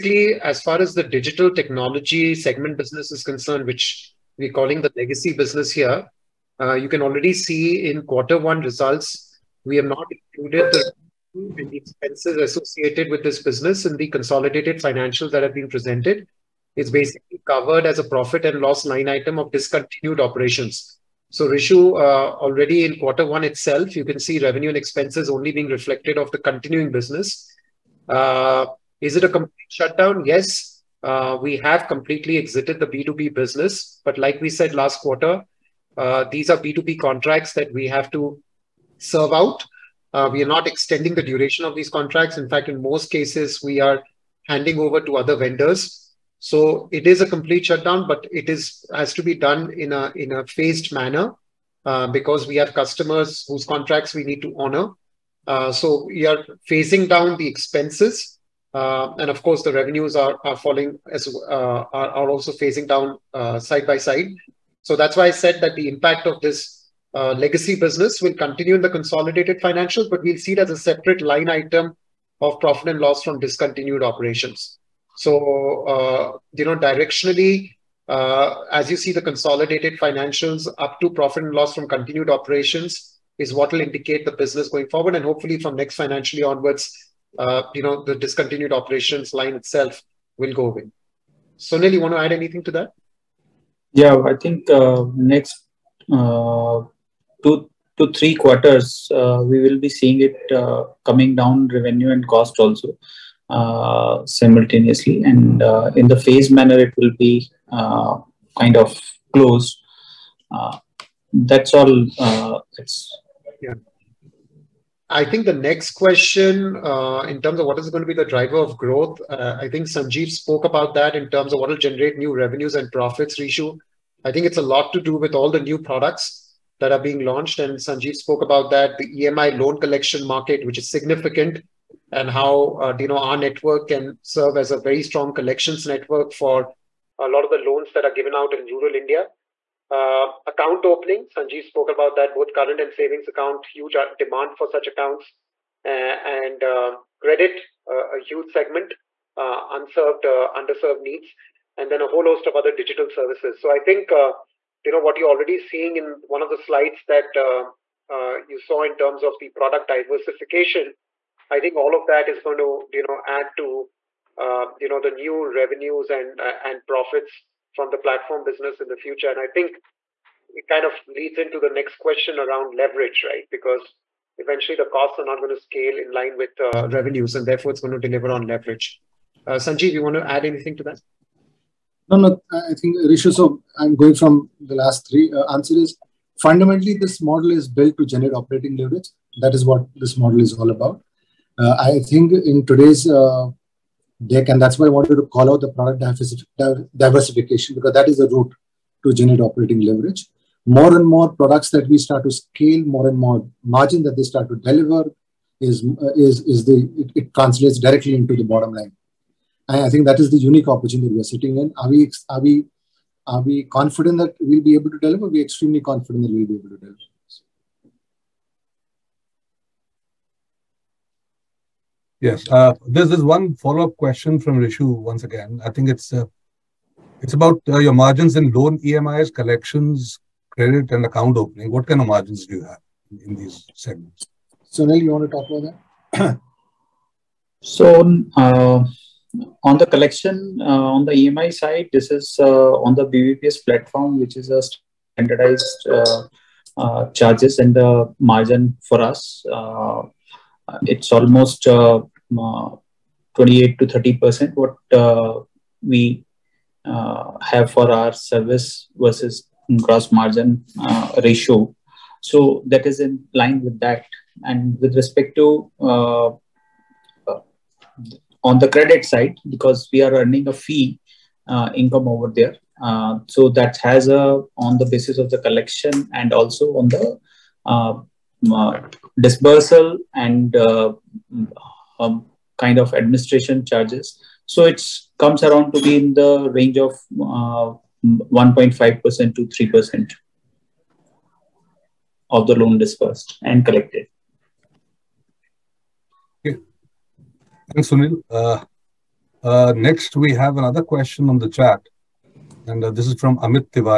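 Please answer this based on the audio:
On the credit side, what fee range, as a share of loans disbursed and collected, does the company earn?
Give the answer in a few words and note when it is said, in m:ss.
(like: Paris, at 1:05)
1.5% to 3%, at 4:47.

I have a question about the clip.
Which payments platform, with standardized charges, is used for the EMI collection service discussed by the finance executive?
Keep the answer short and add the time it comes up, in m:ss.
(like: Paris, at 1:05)
BBPS, at 4:03.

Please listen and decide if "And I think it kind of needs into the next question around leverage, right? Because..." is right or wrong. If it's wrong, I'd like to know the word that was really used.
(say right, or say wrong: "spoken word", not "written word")
wrong: "leads", not "needs".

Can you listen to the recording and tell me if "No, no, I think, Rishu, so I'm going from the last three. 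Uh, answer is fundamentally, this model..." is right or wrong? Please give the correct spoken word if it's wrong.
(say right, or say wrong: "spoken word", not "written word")
right.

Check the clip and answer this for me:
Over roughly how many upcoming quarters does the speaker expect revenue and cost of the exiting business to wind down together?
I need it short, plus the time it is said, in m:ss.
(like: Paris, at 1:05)
2 to 3 quarters, at 1:37.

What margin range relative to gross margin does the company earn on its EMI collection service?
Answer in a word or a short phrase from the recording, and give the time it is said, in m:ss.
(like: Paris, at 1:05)
28 to 30 percent, at 4:11.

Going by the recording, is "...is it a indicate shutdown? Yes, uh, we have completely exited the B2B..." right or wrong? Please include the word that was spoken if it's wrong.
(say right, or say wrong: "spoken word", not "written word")
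wrong: "complete", not "indicate".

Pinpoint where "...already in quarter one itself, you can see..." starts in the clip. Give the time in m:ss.
0:22.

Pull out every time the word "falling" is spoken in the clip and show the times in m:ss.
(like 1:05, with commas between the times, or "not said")
1:00.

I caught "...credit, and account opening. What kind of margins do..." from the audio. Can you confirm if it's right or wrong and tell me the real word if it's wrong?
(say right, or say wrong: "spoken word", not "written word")
right.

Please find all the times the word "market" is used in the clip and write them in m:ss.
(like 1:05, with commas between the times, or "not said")
2:10.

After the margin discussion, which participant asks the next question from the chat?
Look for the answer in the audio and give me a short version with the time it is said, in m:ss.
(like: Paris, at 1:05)
Amit, at 5:03.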